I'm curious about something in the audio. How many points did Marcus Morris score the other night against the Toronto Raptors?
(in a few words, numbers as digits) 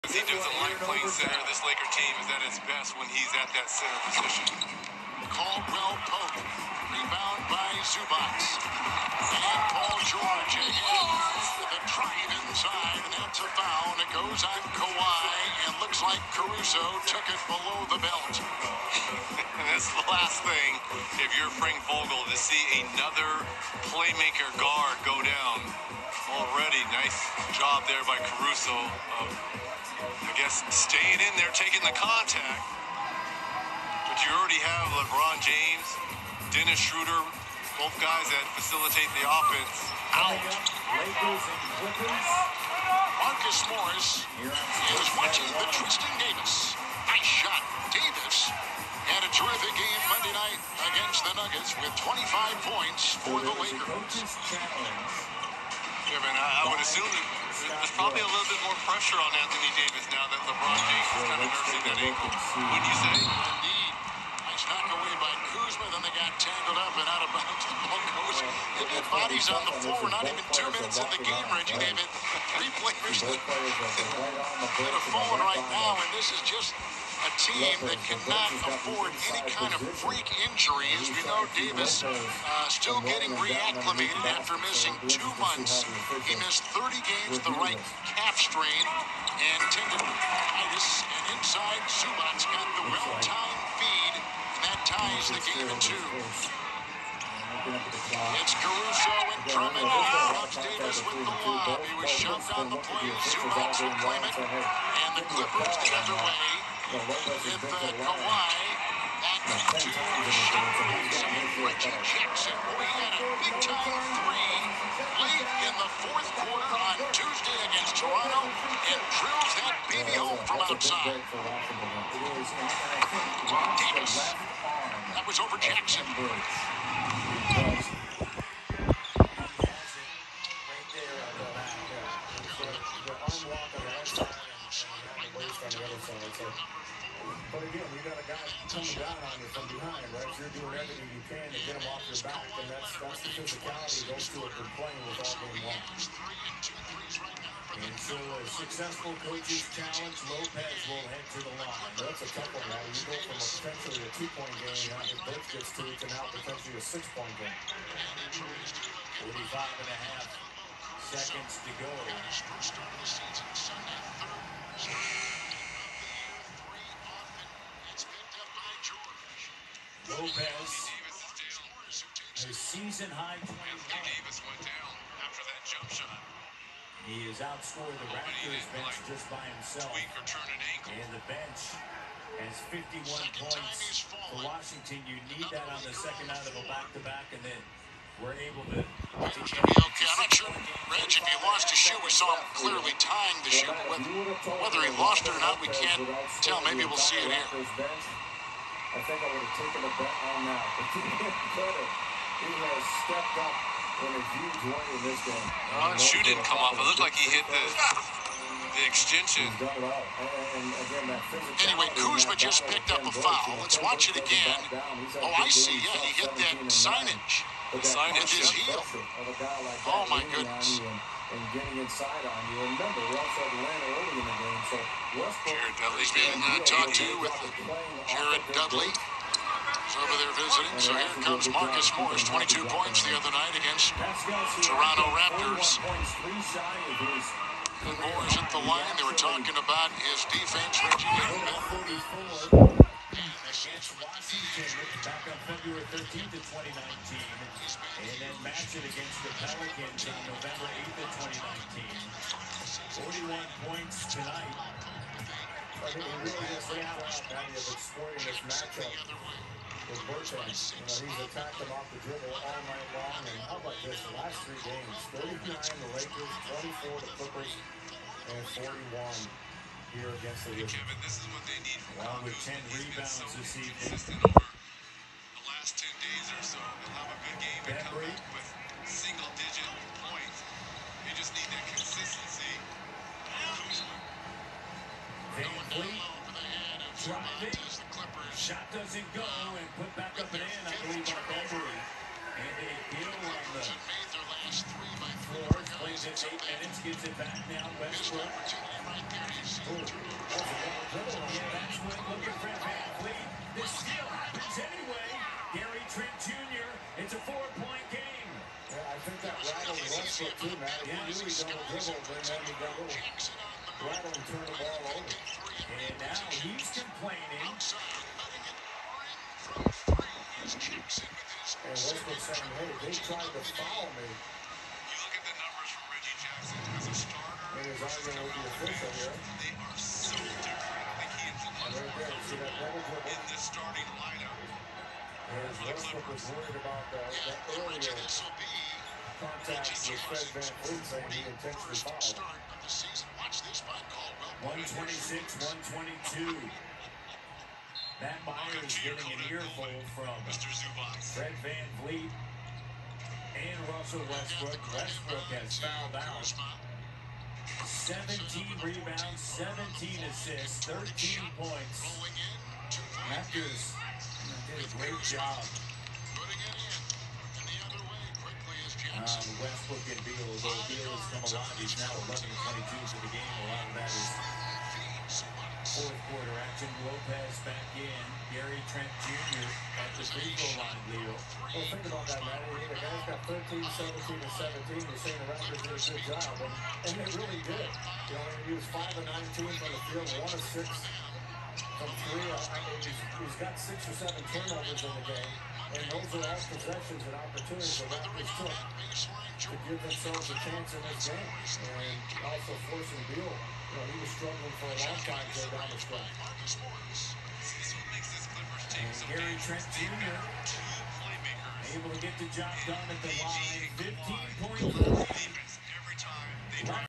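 22.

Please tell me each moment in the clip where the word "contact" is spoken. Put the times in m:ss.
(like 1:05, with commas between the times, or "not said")
0:31, 5:37.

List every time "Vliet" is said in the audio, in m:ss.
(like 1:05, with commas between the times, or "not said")
5:03, 5:40, 5:51.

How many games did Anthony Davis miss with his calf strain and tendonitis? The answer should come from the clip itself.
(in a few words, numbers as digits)
30.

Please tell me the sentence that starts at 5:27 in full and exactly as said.
And his arguing with the official here.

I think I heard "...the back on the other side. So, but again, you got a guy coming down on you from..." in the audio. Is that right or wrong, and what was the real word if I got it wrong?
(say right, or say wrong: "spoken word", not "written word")
right.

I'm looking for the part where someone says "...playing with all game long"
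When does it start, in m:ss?
2:24.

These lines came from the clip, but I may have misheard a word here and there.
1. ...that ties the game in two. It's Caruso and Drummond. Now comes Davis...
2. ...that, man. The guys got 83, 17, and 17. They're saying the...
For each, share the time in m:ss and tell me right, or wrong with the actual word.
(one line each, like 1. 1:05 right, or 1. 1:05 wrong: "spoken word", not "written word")
1. 1:34 right
2. 6:22 wrong: "13", not "83".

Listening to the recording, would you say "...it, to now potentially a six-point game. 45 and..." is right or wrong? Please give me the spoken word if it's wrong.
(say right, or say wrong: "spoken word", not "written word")
right.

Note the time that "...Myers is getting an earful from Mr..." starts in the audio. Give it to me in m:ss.
5:48.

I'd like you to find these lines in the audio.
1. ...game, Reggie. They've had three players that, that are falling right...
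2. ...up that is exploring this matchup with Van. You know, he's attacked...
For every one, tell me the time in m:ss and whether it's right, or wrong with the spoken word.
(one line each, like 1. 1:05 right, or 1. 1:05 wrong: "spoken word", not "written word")
1. 1:11 right
2. 4:17 wrong: "Burton", not "Van".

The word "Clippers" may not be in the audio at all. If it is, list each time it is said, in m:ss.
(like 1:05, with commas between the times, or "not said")
1:45, 4:27, 5:36.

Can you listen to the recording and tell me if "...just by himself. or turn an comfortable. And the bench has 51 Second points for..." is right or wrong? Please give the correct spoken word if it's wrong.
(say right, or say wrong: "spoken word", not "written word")
wrong: "ankle", not "comfortable".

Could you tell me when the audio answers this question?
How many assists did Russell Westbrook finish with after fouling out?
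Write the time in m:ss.
5:59.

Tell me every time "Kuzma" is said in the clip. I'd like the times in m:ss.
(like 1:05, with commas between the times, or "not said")
1:05, 3:31.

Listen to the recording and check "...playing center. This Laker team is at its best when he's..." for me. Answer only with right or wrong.
right.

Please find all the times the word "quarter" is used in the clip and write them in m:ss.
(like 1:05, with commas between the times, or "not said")
1:56, 6:16.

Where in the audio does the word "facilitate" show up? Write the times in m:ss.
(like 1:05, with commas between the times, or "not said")
0:38.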